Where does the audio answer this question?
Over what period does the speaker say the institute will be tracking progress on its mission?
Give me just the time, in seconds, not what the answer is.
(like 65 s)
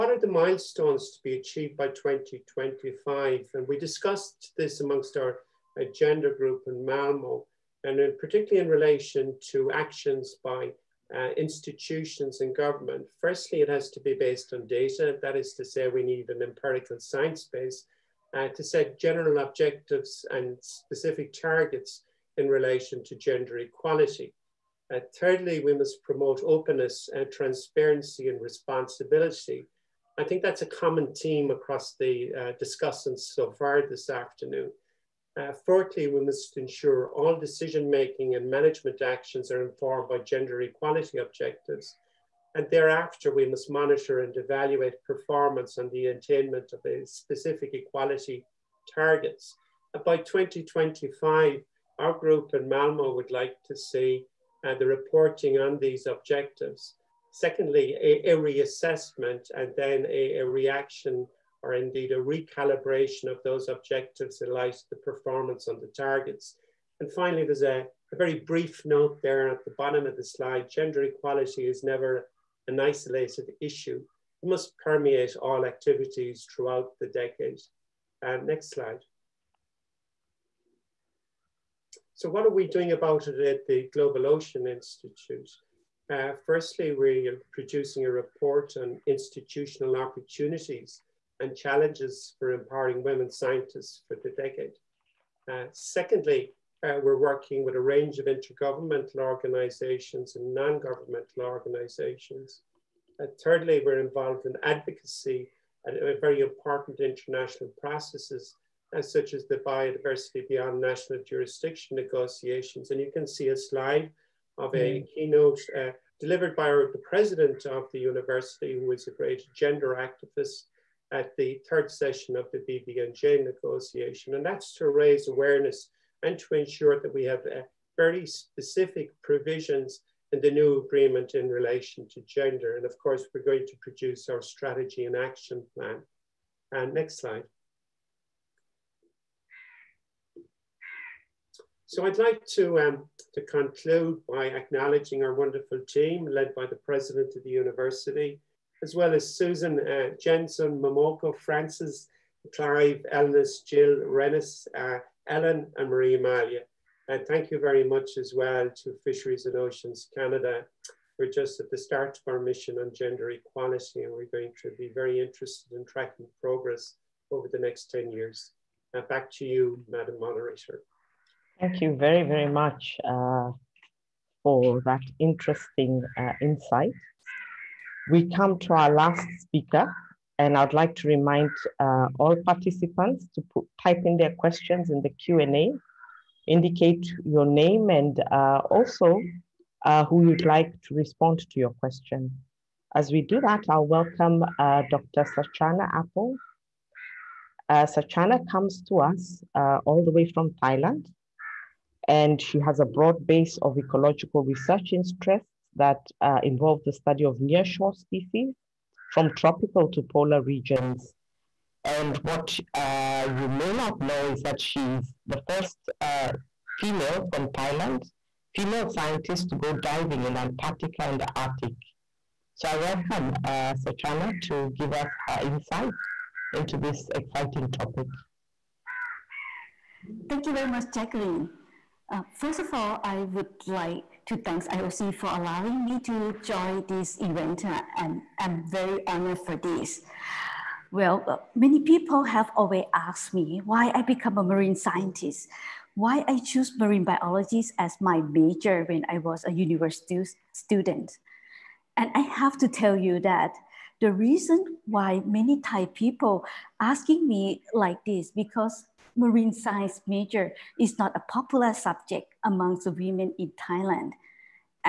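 167 s.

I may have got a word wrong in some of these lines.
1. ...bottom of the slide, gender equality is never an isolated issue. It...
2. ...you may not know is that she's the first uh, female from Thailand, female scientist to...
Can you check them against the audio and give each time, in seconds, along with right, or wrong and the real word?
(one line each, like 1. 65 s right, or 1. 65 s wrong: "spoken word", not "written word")
1. 69 s right
2. 213 s right.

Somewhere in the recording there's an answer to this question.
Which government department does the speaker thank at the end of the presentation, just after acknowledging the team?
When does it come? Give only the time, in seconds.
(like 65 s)
159 s.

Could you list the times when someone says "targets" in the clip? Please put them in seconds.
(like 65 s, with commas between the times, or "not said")
21 s, 48 s, 65 s.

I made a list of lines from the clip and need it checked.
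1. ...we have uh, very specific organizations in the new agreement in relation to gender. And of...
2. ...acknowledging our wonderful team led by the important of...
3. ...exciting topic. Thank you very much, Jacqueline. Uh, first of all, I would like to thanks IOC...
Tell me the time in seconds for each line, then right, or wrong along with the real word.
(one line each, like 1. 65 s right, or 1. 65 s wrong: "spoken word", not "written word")
1. 127 s wrong: "provisions", not "organizations"
2. 144 s wrong: "president", not "important"
3. 227 s right.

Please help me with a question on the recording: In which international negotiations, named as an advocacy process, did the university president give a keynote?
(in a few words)
Biodiversity beyond national jurisdiction.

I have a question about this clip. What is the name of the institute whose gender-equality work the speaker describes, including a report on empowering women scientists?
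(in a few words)
Global Ocean Institute.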